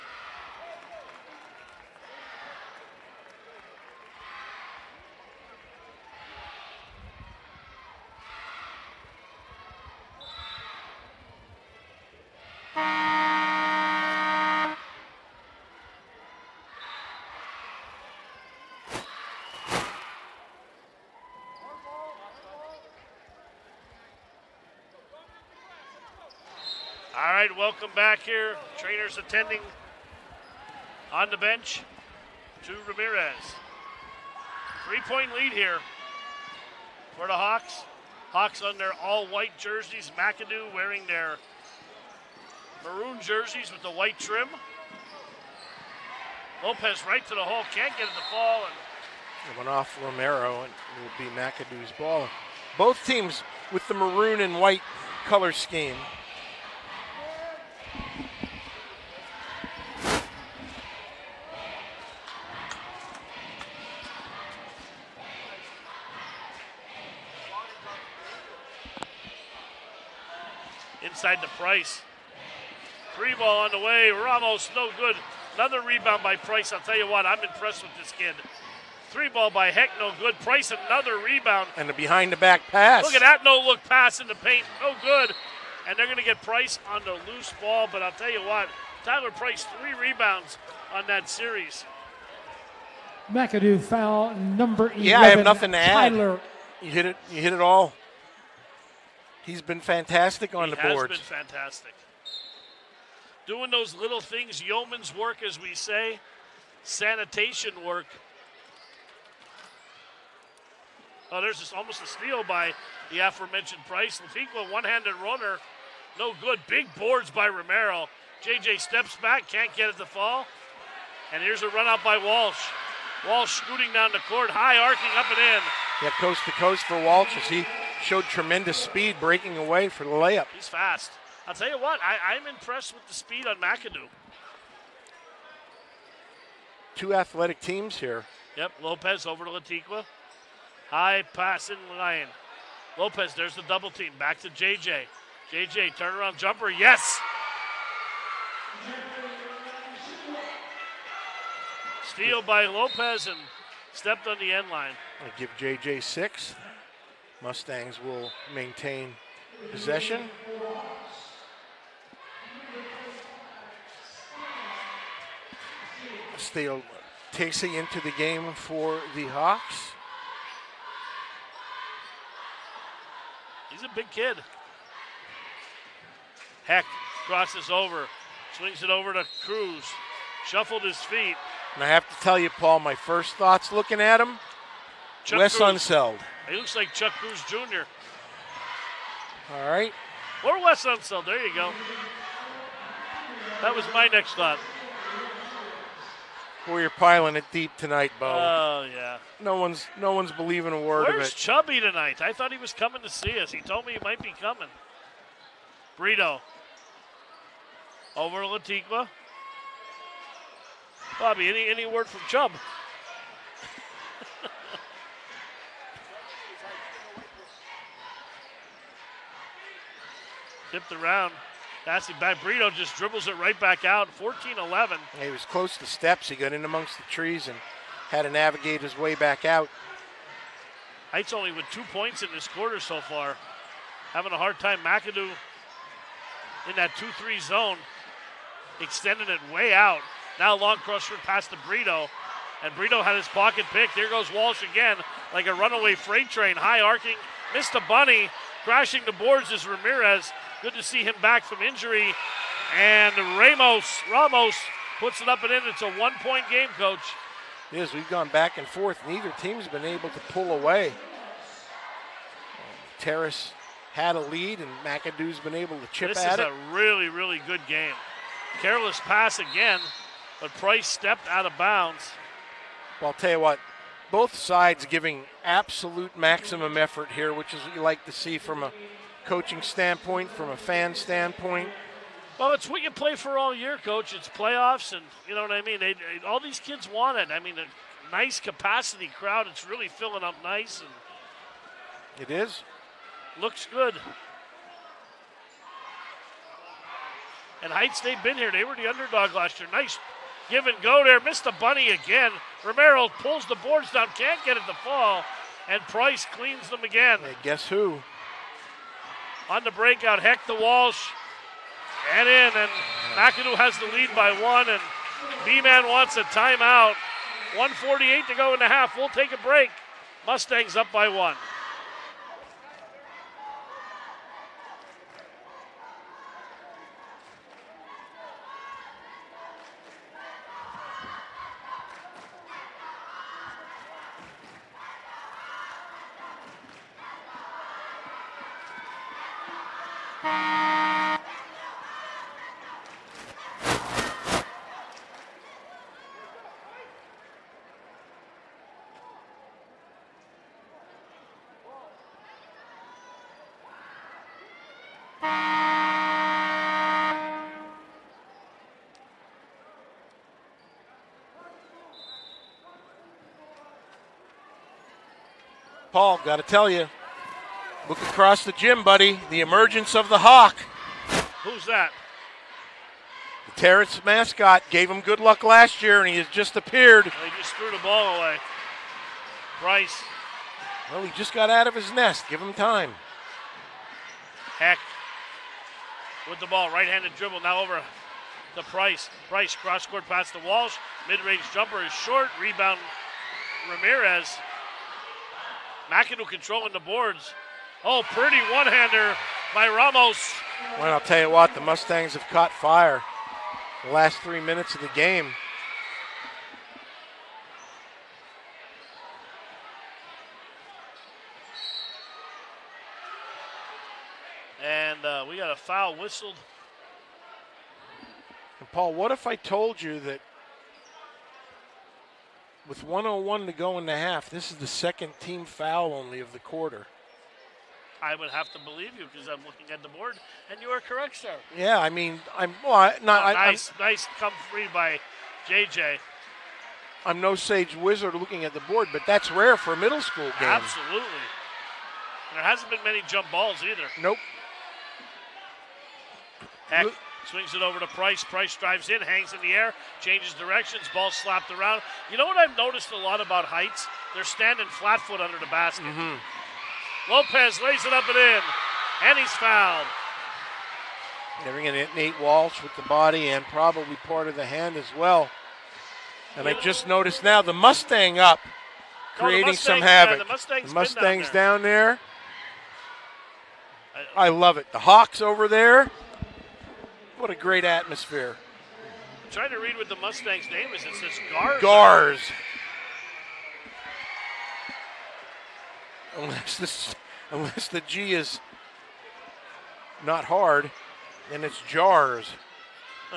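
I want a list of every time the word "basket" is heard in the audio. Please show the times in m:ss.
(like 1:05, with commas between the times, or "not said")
7:35.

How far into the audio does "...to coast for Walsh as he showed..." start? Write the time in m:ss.
2:06.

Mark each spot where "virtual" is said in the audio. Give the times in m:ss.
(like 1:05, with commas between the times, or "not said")
not said.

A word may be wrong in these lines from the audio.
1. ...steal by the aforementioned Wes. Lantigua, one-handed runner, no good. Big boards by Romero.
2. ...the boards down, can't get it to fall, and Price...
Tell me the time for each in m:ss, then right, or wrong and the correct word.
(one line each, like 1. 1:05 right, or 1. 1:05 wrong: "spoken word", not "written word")
1. 1:52 wrong: "Price", not "Wes"
2. 5:03 right.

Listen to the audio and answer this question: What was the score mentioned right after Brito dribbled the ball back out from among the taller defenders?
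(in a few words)
14-11.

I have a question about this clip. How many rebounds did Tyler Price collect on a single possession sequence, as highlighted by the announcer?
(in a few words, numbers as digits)
3.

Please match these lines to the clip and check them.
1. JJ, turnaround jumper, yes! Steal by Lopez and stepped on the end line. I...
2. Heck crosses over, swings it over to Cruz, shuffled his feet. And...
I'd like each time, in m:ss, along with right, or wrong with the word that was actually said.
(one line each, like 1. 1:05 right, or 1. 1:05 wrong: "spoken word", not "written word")
1. 2:25 right
2. 2:56 right.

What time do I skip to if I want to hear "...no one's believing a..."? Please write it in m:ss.
3:19.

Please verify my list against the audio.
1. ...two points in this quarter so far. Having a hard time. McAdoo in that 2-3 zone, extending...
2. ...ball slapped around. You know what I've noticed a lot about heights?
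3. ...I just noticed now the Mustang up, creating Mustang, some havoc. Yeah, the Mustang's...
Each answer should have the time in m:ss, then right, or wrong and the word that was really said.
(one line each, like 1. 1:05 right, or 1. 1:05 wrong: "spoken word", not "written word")
1. 3:51 right
2. 7:30 right
3. 7:46 right.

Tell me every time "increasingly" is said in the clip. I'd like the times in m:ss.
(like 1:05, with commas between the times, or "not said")
not said.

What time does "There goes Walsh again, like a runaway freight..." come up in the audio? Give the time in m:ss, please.
4:03.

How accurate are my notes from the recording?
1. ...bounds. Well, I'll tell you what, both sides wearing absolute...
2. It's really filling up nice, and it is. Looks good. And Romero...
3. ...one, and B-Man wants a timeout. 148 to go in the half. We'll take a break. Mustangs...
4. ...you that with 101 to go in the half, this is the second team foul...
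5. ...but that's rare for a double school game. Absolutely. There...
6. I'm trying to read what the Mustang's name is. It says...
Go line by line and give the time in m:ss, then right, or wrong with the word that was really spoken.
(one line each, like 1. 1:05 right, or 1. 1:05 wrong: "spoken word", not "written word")
1. 4:31 wrong: "giving", not "wearing"
2. 4:49 wrong: "Heights", not "Romero"
3. 5:14 right
4. 6:59 right
5. 7:18 wrong: "middle", not "double"
6. 7:59 right.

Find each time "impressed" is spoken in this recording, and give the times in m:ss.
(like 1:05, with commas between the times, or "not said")
1:17, 2:12.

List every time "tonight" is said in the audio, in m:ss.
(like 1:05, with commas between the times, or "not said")
3:17, 3:21.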